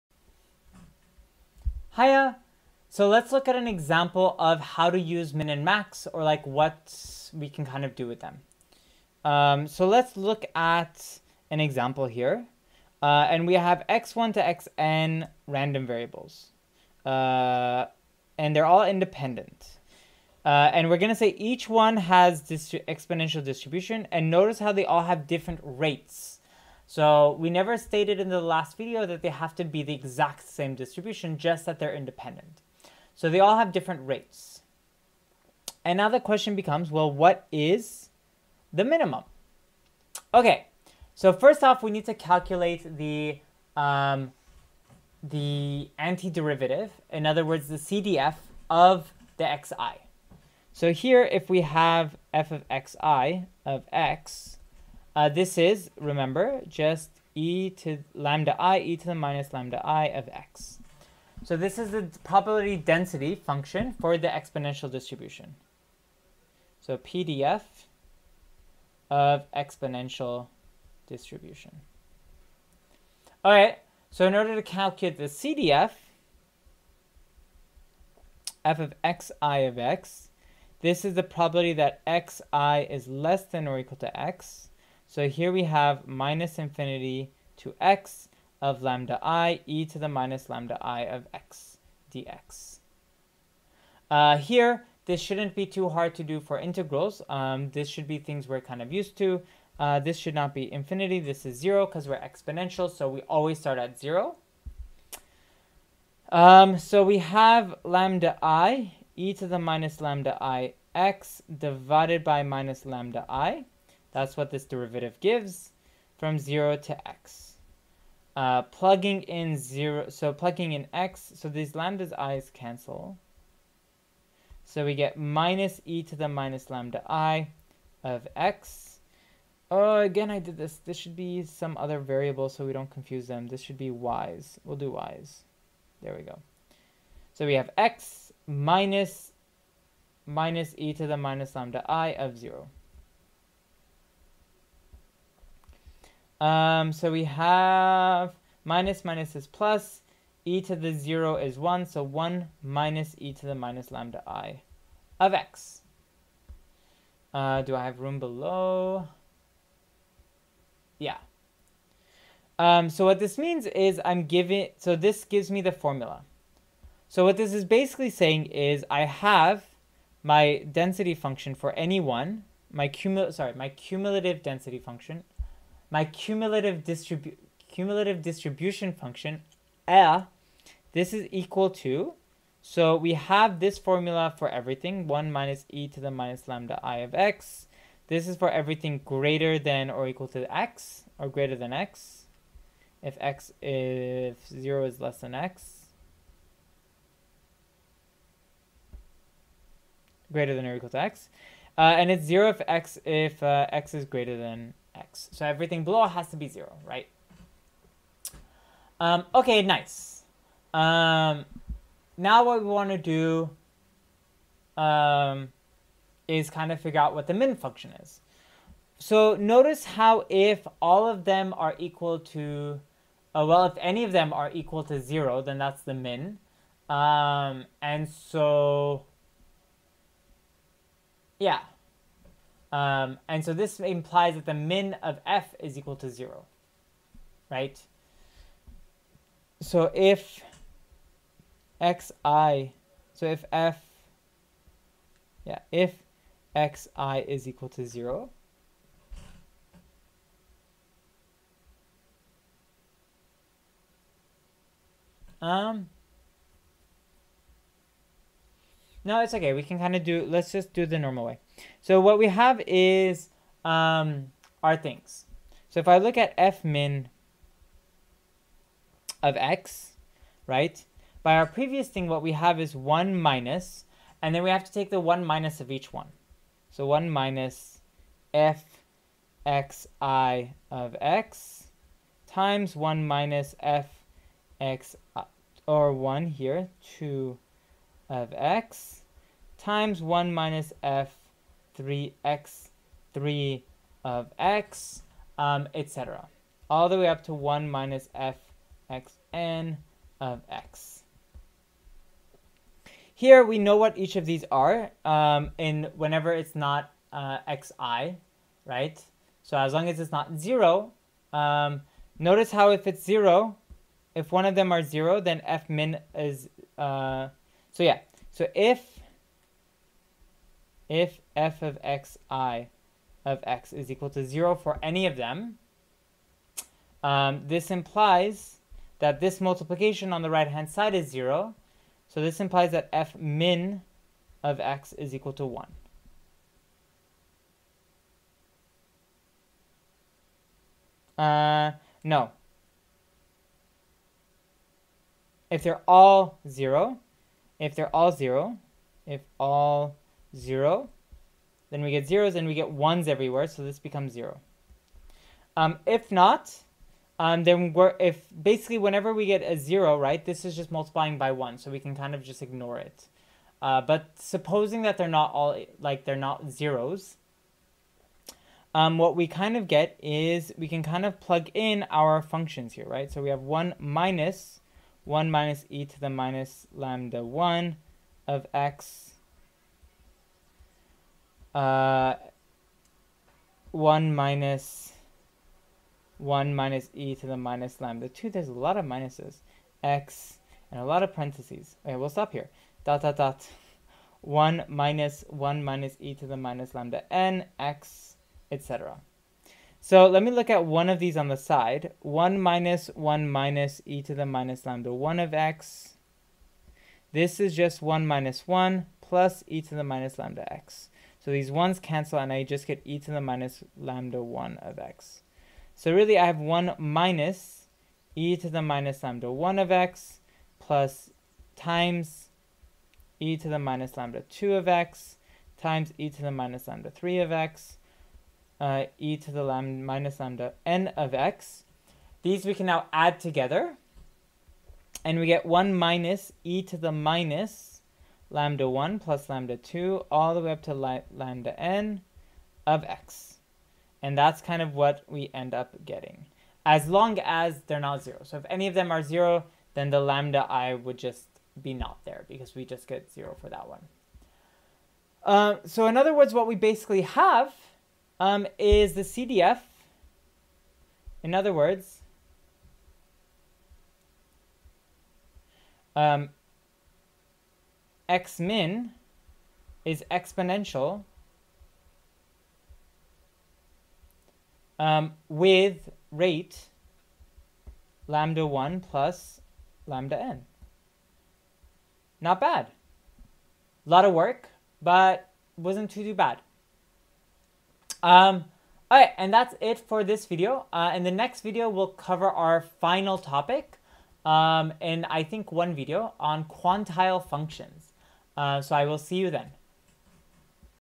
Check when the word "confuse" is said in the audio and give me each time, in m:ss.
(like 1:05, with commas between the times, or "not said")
2:12.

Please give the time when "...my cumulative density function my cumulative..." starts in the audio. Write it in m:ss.
2:53.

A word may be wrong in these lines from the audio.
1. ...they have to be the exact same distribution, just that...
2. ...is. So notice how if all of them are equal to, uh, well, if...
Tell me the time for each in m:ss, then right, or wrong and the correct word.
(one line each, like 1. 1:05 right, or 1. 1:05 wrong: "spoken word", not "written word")
1. 0:29 right
2. 3:38 right.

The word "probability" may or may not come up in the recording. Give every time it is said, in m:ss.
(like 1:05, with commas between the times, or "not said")
1:02, 1:21.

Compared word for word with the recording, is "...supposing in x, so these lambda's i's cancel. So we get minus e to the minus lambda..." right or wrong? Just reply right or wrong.
wrong.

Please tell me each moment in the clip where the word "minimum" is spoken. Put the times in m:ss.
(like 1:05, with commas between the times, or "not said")
0:38.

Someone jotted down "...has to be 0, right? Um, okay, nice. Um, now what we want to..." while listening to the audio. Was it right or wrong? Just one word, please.
right.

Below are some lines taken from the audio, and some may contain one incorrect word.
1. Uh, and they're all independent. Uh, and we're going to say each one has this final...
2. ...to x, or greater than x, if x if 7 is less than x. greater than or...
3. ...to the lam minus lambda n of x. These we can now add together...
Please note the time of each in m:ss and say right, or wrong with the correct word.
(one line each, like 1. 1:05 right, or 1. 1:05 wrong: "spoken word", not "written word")
1. 0:17 wrong: "exponential", not "final"
2. 3:10 wrong: "0", not "7"
3. 7:09 right.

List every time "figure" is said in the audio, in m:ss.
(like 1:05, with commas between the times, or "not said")
3:36.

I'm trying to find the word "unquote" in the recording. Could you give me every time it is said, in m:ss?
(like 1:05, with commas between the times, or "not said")
not said.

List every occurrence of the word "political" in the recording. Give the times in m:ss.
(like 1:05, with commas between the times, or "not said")
not said.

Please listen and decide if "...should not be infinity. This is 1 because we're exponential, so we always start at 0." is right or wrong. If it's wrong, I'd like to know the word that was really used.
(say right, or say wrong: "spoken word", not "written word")
wrong: "0", not "1".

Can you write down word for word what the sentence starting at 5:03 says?
Here we know what each of these are um, in whenever it's not uh, xi, right?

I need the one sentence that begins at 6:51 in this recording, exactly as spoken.
So these 1s cancel and I just get e to the minus lambda 1 of x.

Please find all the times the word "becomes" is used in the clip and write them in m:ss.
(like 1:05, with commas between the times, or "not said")
0:36, 5:53.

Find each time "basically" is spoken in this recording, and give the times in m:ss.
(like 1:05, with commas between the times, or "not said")
2:47, 5:58, 7:36.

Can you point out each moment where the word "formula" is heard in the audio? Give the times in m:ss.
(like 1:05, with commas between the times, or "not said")
2:45, 3:03.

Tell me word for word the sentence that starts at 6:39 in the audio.
So let me look at one of these on the side.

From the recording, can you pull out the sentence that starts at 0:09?
Um, so let's look at an example here.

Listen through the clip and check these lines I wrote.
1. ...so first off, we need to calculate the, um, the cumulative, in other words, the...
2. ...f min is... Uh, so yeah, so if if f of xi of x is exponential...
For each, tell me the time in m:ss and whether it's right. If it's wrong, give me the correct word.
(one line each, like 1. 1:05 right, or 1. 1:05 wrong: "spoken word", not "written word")
1. 0:41 wrong: "antiderivative", not "cumulative"
2. 5:15 wrong: "equal", not "exponential".